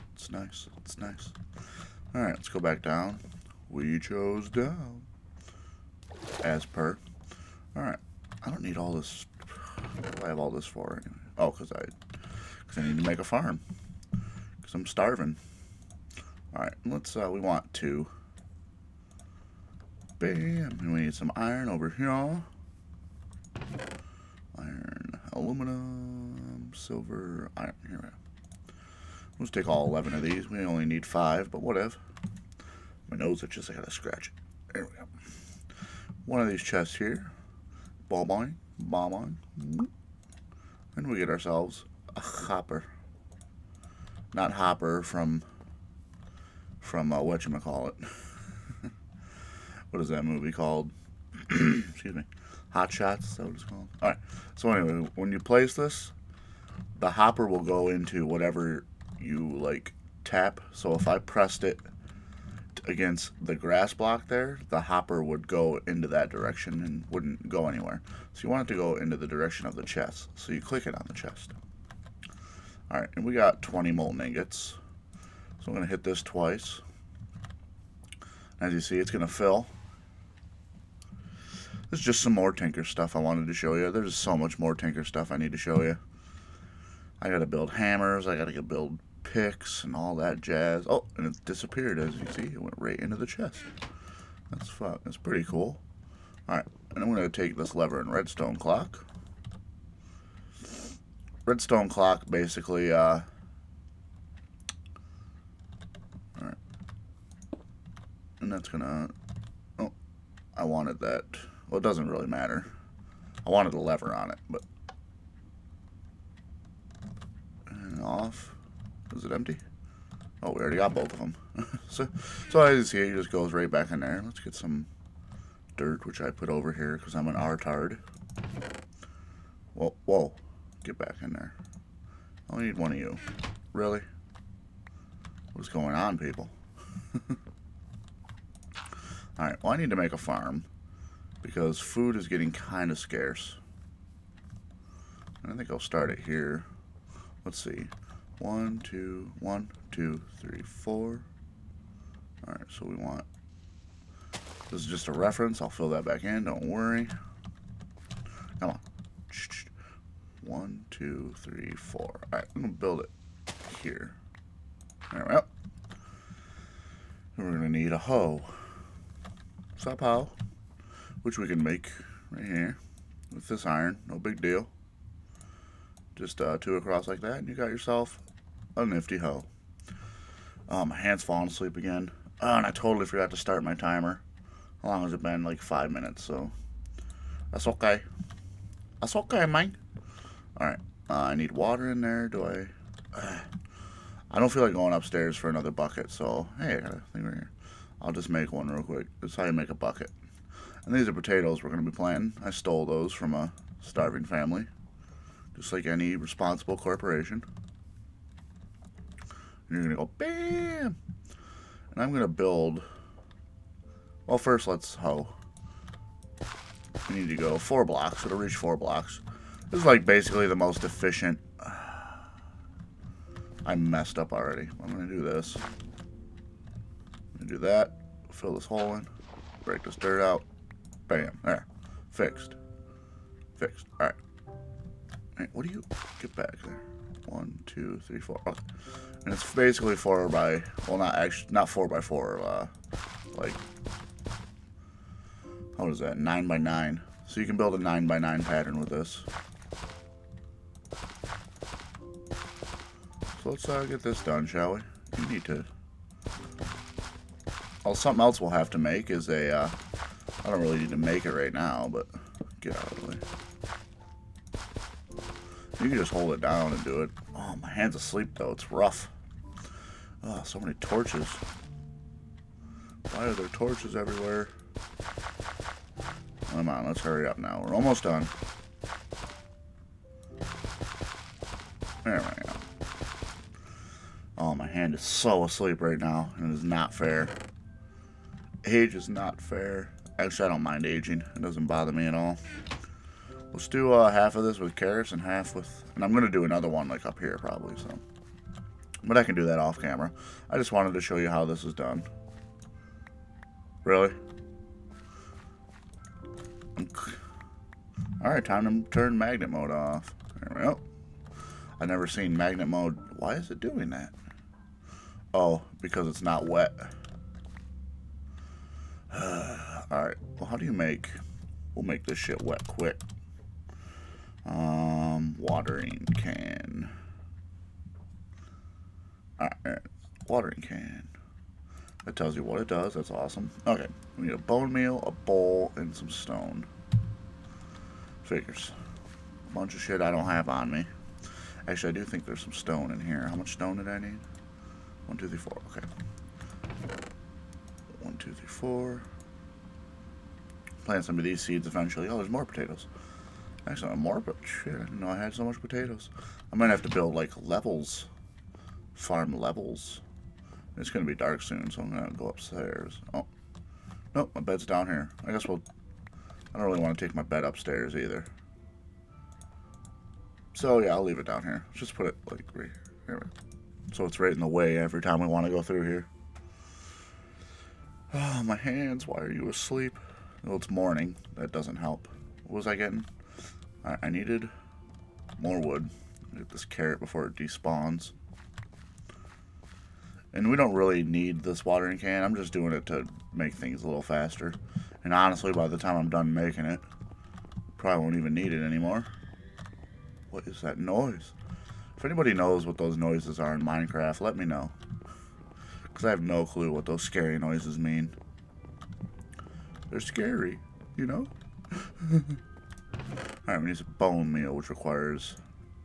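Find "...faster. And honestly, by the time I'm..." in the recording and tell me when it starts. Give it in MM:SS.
06:34.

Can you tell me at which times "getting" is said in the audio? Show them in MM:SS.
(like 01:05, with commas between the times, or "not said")
02:22, 06:22.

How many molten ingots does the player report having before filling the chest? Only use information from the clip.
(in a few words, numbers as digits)
20.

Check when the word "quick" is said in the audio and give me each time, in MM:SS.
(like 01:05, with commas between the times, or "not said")
03:18, 05:22.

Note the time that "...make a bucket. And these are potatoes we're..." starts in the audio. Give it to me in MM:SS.
03:19.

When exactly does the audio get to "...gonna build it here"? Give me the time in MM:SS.
02:42.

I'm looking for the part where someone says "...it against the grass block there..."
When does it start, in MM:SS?
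01:01.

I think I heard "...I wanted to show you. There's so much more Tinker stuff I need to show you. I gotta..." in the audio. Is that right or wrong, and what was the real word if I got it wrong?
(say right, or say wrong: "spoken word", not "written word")
right.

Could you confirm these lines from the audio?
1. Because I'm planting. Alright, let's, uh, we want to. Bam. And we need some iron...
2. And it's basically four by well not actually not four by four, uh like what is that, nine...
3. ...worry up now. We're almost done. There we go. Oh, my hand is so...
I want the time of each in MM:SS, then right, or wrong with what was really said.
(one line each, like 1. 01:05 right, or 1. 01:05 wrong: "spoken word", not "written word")
1. 00:14 wrong: "starving", not "planting"
2. 03:59 right
3. 04:37 wrong: "hurry", not "worry".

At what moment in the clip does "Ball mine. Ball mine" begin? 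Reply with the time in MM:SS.
00:38.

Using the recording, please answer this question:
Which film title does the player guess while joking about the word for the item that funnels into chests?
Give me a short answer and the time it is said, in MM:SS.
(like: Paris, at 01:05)
Hot Shots, at 00:52.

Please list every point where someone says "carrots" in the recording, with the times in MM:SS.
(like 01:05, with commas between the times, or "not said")
04:54, 06:26.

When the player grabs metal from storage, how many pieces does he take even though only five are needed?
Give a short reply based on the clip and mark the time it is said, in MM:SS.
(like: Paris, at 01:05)
11, at 00:29.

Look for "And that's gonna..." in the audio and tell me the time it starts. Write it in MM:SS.
01:48.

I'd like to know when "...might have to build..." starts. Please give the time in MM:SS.
05:56.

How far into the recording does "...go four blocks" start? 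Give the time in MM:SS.
03:37.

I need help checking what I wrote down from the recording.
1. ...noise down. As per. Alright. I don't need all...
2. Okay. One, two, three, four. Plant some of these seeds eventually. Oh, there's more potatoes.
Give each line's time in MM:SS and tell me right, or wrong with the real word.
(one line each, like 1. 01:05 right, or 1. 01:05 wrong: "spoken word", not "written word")
1. 00:03 wrong: "chose", not "noise"
2. 05:45 right.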